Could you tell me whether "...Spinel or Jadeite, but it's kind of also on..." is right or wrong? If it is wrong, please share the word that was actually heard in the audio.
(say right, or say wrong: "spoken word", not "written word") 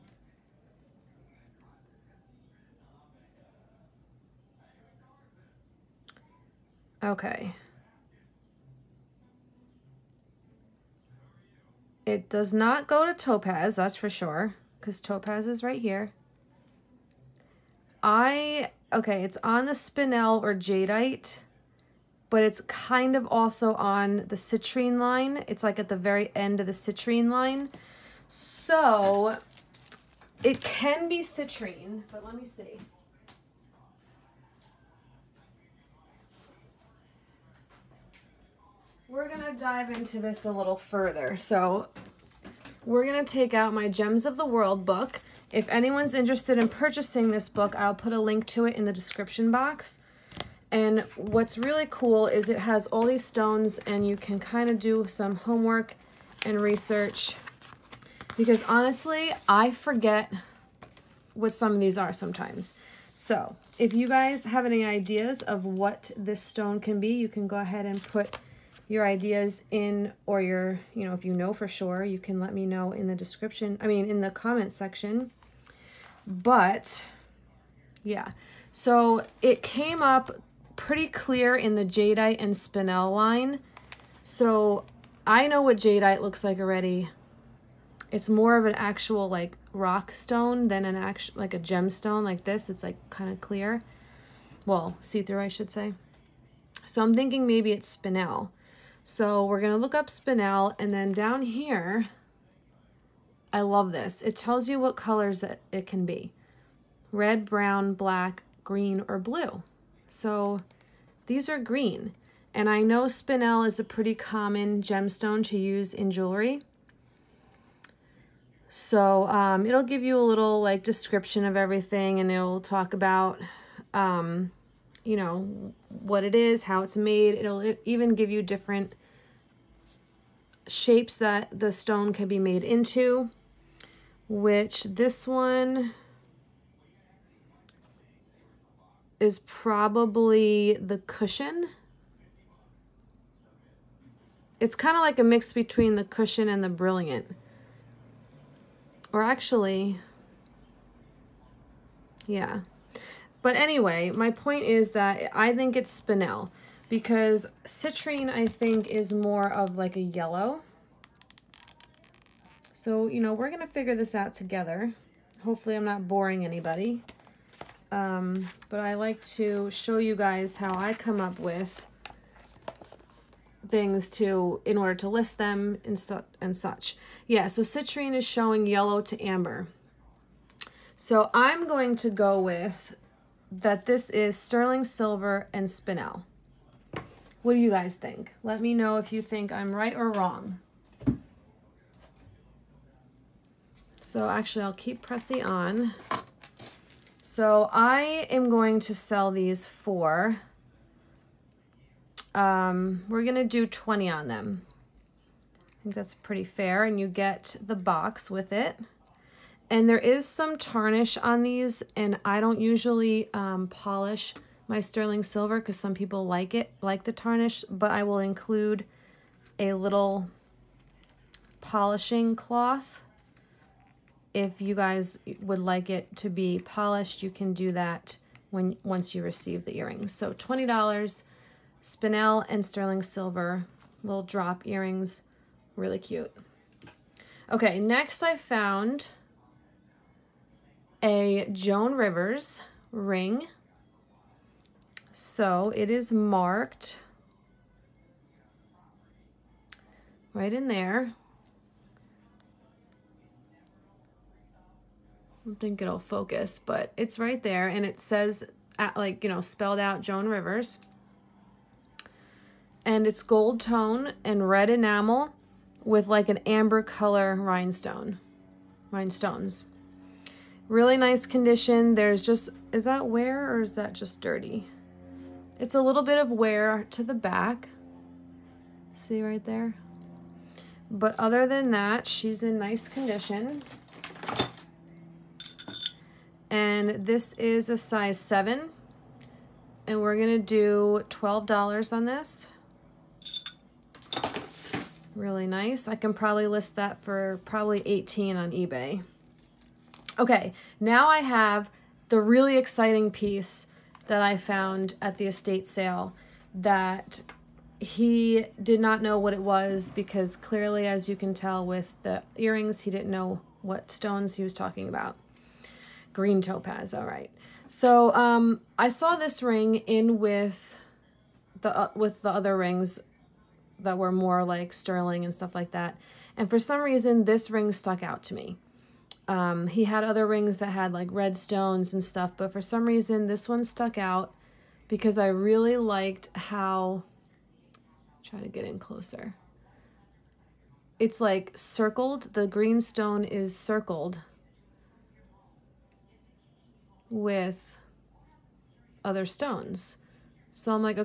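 right.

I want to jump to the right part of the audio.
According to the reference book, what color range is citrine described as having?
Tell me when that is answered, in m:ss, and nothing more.
2:58.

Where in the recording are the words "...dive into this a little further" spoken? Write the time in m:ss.
0:39.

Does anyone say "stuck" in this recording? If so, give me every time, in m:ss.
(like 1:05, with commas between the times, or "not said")
5:27, 5:33.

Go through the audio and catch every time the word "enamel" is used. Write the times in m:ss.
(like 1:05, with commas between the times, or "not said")
4:24.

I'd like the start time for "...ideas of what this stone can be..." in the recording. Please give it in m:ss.
1:04.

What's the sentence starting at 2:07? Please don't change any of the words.
It'll even give you different shapes that the stone can be made into, which this one is probably the cushion.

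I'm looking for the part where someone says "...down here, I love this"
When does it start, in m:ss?
1:41.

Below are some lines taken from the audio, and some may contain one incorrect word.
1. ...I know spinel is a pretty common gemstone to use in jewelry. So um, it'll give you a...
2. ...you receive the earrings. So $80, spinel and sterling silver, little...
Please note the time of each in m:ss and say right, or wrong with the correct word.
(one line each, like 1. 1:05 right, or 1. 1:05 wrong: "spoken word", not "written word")
1. 1:52 right
2. 3:49 wrong: "20", not "80".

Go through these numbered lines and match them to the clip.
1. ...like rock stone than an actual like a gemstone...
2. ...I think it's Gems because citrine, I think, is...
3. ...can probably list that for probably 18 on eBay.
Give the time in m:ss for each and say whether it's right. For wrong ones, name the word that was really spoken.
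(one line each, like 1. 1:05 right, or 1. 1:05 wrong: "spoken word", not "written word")
1. 1:29 right
2. 2:35 wrong: "Spinel", not "Gems"
3. 4:55 right.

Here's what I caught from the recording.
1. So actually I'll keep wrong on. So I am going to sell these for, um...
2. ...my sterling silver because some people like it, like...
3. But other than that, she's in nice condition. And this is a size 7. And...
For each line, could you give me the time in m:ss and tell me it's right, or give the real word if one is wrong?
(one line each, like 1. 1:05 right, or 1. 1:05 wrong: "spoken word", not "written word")
1. 3:14 wrong: "pressing", not "wrong"
2. 3:34 right
3. 4:40 right.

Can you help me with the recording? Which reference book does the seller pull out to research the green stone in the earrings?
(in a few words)
Gems of the World.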